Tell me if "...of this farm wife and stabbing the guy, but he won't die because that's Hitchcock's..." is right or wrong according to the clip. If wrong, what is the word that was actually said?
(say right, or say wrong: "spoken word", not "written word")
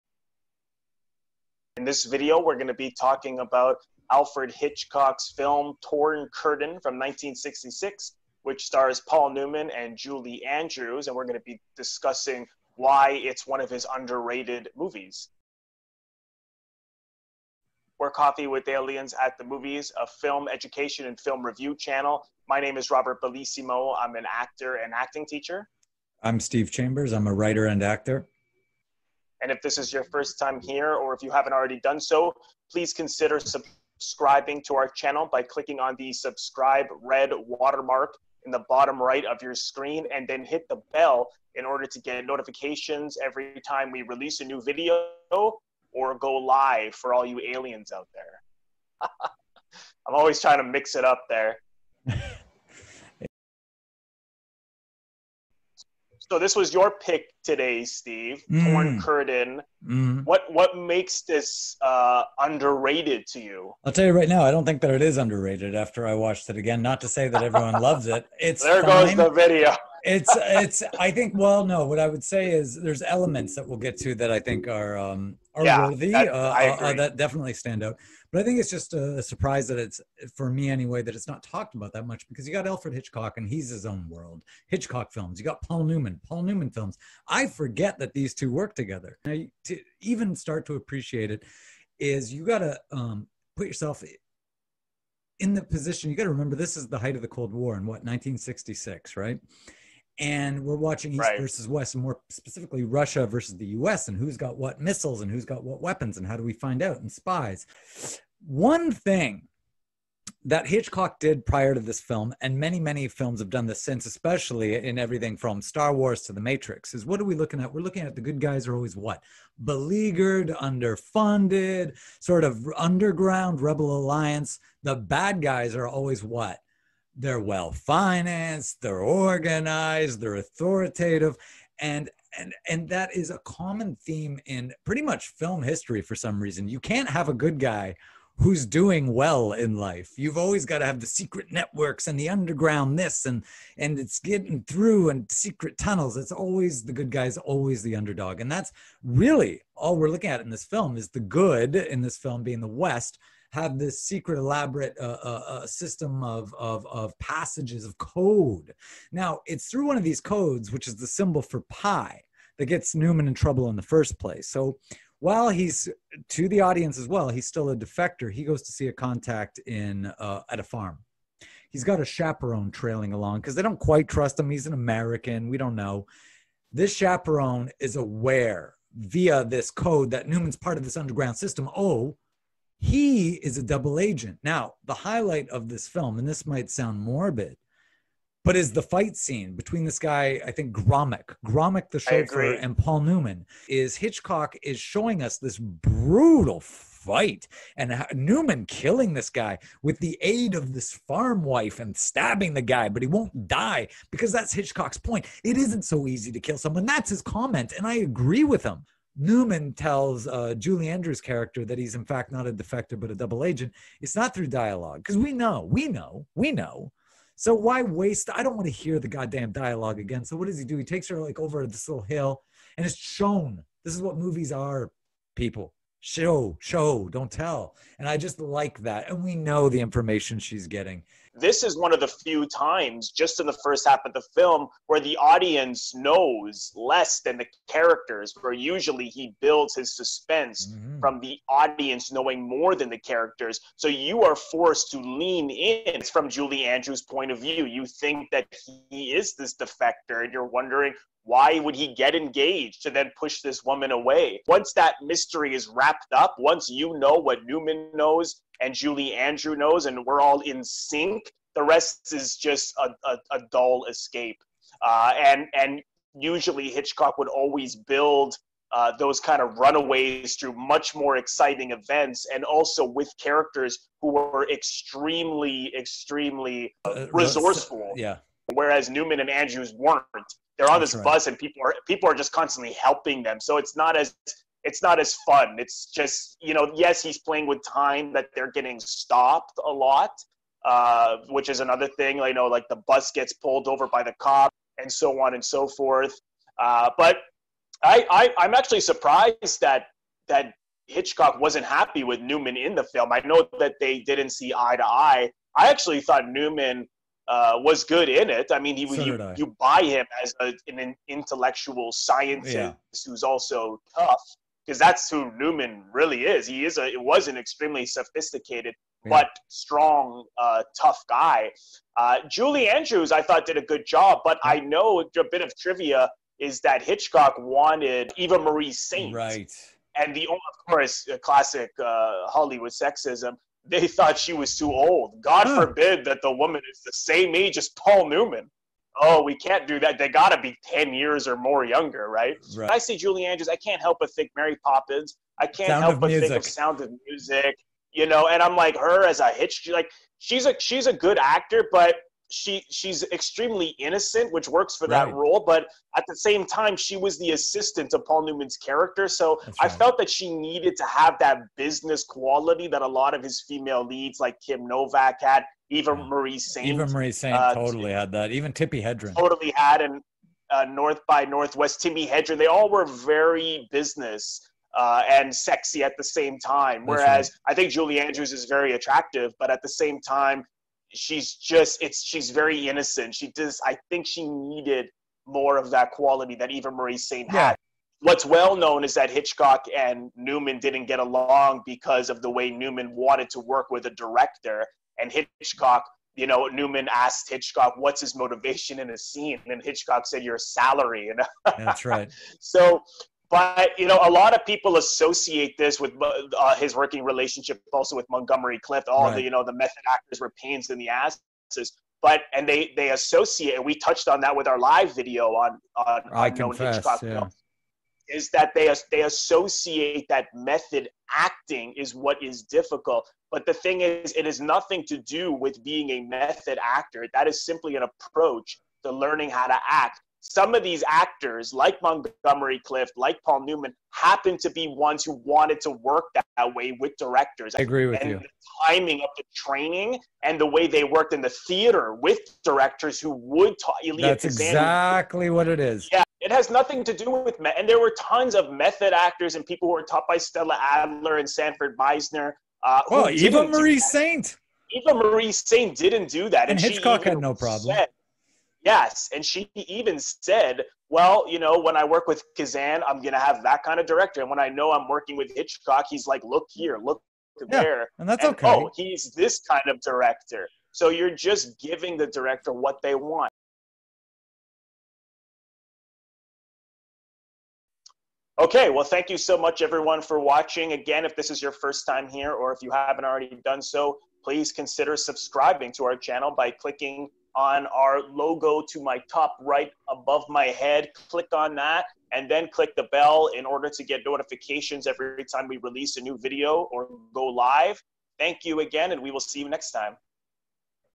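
right.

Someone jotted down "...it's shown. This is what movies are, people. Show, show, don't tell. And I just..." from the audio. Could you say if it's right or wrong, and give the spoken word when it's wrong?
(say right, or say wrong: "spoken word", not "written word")
right.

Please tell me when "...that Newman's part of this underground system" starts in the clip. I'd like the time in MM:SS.
03:00.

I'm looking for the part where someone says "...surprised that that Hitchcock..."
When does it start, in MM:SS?
04:58.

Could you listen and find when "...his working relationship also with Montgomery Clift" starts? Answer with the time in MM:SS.
06:46.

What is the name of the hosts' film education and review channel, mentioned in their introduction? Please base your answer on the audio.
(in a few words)
Coffee with Aliens at the Movies.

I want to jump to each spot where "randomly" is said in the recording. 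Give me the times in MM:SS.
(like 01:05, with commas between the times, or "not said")
not said.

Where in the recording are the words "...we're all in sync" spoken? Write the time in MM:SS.
04:20.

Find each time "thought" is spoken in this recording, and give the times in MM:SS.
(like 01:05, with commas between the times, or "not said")
05:06, 05:23, 05:33.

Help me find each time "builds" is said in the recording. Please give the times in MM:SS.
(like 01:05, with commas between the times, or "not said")
03:59, 04:27.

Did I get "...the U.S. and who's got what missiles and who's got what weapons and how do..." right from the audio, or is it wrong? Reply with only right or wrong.
right.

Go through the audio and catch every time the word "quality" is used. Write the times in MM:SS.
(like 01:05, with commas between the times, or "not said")
06:02, 06:25.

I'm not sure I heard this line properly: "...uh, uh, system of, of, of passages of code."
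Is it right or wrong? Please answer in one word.
right.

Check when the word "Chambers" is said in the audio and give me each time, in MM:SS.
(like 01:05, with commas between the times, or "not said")
00:26.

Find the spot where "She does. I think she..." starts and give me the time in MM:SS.
06:23.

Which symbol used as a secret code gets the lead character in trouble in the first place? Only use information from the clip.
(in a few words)
pi.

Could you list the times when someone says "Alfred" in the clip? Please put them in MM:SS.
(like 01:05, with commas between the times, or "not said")
00:04, 01:22.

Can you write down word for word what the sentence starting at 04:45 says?
It's just you know, yes, he's playing with time that they're getting stopped a lot, uh, which is another thing.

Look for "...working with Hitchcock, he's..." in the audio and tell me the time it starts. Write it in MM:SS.
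07:44.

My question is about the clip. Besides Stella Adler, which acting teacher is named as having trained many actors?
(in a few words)
Sanford Meisner.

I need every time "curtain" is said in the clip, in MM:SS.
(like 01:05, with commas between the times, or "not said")
00:06, 00:59.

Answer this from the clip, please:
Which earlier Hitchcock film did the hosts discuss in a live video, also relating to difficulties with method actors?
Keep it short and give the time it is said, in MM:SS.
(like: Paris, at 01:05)
I Confess, at 06:56.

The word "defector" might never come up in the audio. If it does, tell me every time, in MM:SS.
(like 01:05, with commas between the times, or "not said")
02:47, 03:32, 04:09.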